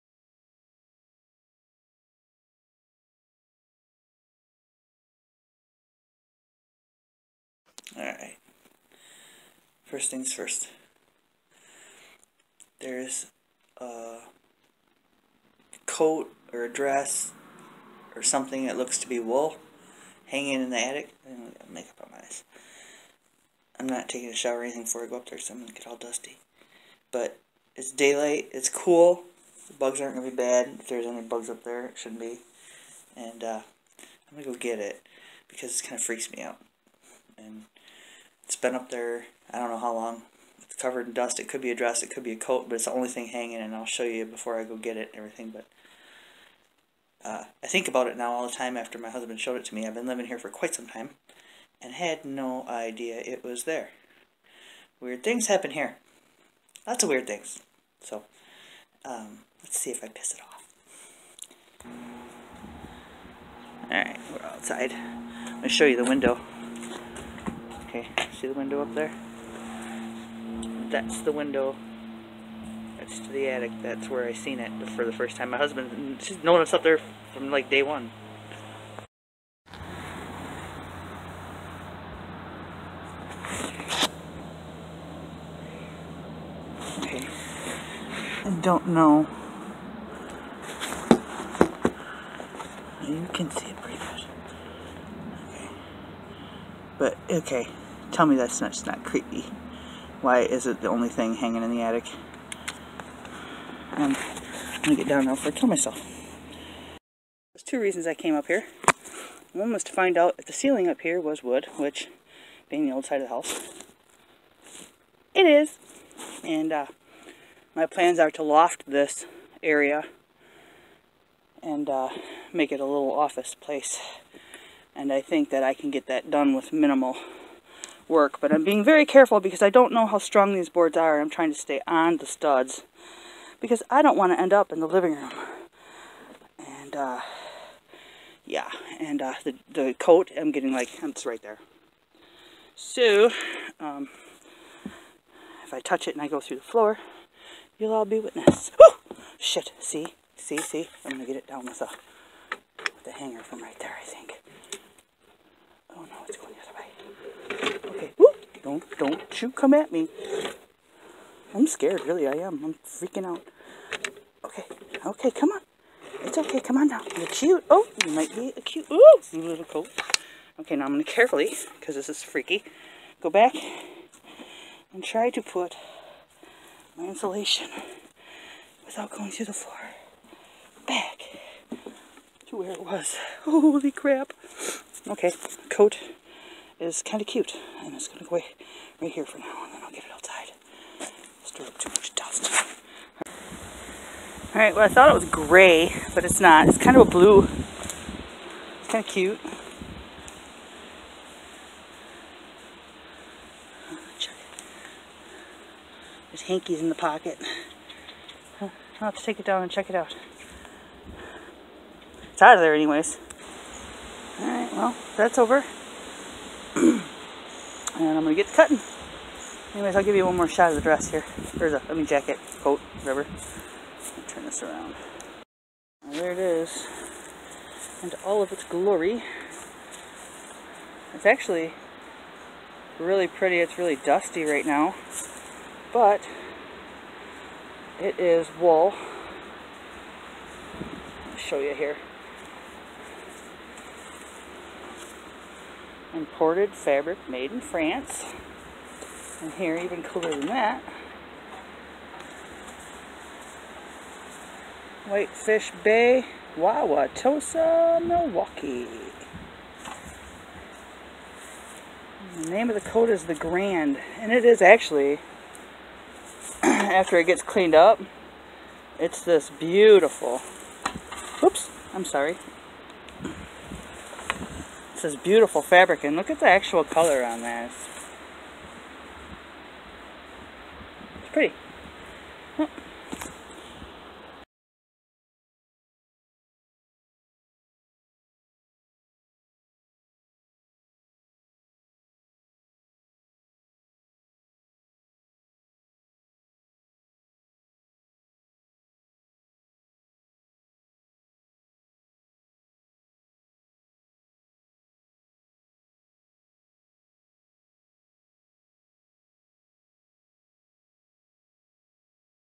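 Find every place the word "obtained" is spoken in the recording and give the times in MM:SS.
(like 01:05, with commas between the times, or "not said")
not said.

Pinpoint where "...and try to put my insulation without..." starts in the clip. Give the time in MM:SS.
02:54.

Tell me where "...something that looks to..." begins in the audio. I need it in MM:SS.
00:18.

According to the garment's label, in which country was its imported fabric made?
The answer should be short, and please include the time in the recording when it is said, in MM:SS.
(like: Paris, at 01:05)
France, at 04:07.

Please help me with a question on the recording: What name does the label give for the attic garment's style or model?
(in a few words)
the Grand.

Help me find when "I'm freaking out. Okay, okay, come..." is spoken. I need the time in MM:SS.
02:42.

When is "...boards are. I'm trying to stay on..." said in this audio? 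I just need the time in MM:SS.
02:10.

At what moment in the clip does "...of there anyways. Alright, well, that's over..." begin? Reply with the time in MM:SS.
03:32.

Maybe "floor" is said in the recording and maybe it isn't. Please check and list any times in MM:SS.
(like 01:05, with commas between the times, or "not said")
02:26, 02:59.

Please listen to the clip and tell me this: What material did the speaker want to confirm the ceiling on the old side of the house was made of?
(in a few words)
wood.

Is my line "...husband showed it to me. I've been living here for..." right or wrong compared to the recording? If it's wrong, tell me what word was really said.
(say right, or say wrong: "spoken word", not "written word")
right.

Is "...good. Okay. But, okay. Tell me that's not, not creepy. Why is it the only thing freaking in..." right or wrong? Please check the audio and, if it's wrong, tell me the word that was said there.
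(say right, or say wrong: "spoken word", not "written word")
wrong: "hanging", not "freaking".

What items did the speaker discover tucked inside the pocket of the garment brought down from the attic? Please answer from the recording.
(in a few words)
hankies.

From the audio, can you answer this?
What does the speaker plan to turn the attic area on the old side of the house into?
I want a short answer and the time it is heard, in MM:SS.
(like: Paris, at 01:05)
a little office, at 02:02.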